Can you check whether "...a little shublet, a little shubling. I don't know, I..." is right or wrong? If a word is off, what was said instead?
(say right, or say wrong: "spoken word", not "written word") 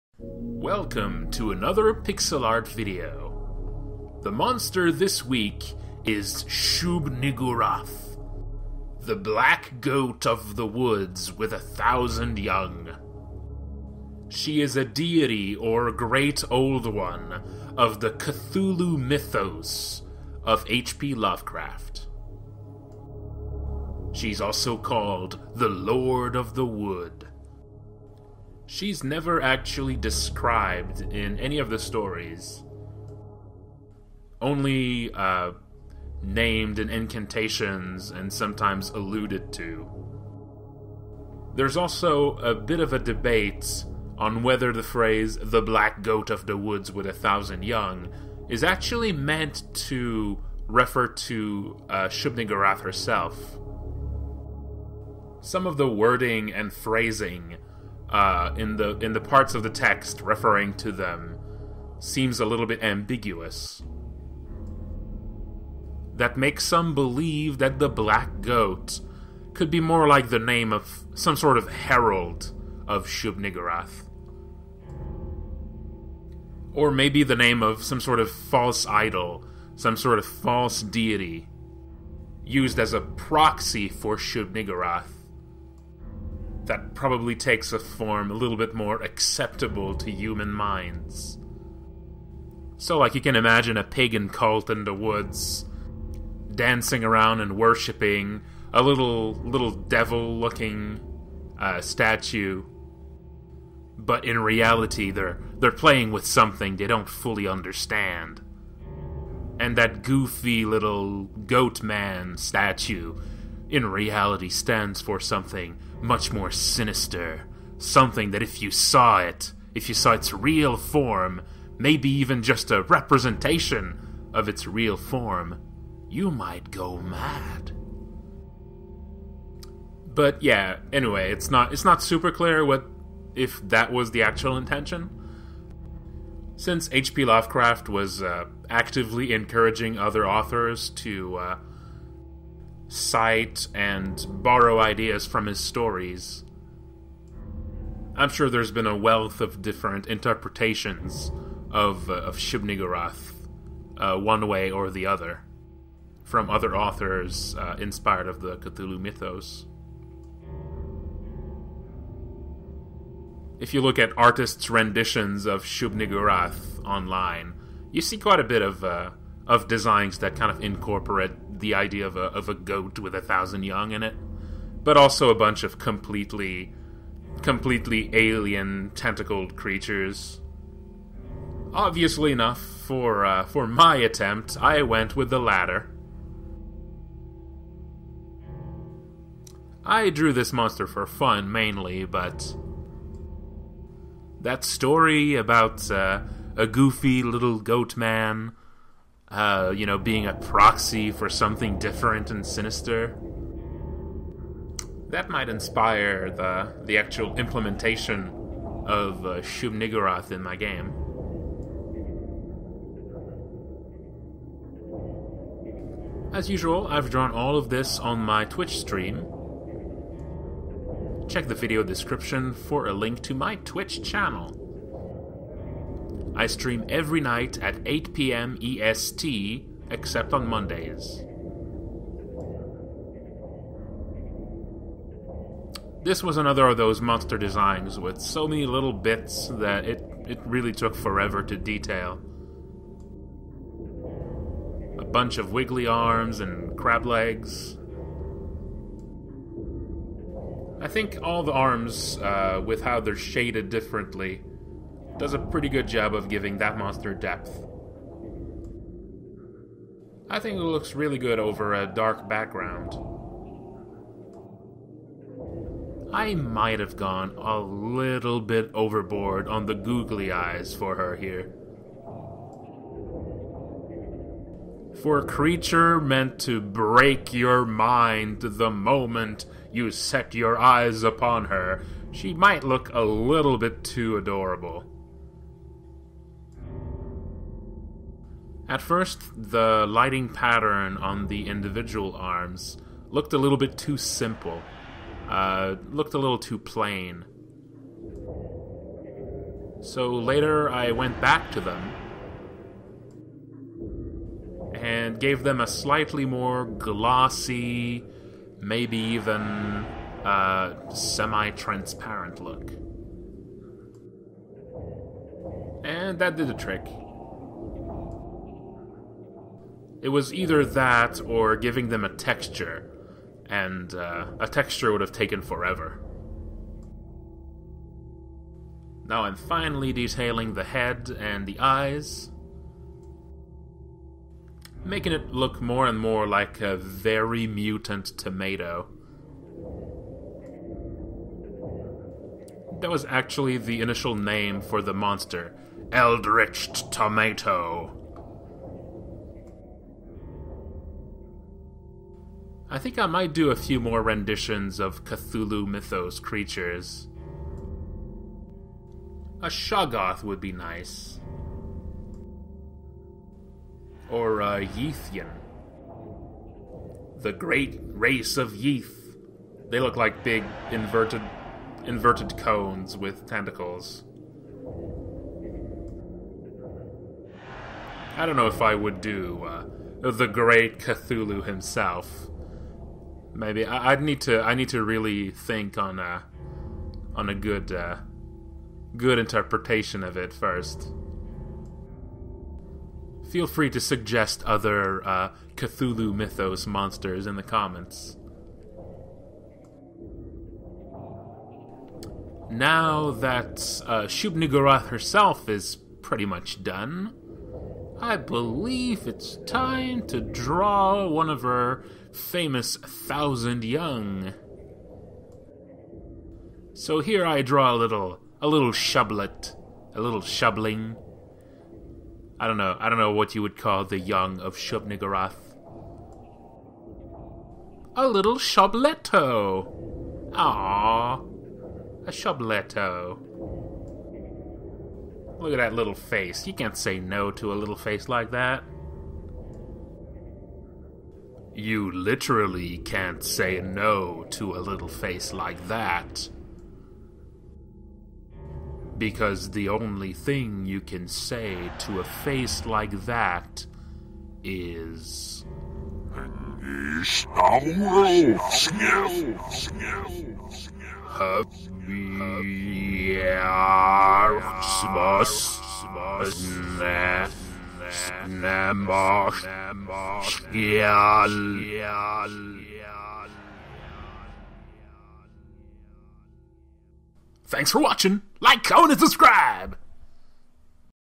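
right.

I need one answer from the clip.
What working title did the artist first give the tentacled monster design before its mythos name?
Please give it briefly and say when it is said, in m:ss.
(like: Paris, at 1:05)
Eldritch Tomato, at 5:45.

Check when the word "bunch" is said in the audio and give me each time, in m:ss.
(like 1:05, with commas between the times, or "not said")
2:55, 4:05.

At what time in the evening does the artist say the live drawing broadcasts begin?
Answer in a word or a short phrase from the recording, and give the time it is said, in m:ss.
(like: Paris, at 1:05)
8 p.m. EST, at 3:47.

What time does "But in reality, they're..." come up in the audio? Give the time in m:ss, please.
1:43.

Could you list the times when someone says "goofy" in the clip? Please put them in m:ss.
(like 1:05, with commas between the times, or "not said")
1:50, 3:16.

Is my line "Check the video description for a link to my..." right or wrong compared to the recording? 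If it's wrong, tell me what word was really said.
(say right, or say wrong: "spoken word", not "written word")
right.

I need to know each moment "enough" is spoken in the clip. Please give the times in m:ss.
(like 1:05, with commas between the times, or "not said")
3:02.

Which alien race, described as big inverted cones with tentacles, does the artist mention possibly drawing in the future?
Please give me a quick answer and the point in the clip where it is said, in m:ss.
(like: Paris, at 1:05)
Yithian, at 6:04.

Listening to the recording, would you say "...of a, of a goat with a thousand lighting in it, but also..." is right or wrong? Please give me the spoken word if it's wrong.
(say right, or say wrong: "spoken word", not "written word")
wrong: "young", not "lighting".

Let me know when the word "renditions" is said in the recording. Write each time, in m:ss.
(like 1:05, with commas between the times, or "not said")
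2:44, 5:54.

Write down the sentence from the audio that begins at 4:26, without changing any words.
I might have gone a little bit overboard on the googly eyes for her here.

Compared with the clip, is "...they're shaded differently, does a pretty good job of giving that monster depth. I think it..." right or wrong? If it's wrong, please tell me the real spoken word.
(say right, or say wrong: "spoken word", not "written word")
right.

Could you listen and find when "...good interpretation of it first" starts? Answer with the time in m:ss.
6:28.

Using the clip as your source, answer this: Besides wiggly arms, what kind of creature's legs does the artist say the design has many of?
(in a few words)
Crab.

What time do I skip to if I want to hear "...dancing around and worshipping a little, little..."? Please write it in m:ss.
1:36.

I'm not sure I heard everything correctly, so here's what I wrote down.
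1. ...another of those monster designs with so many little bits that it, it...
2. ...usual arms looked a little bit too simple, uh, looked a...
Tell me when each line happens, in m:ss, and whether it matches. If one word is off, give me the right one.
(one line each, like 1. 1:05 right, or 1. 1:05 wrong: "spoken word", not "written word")
1. 3:56 right
2. 4:51 wrong: "individual", not "usual".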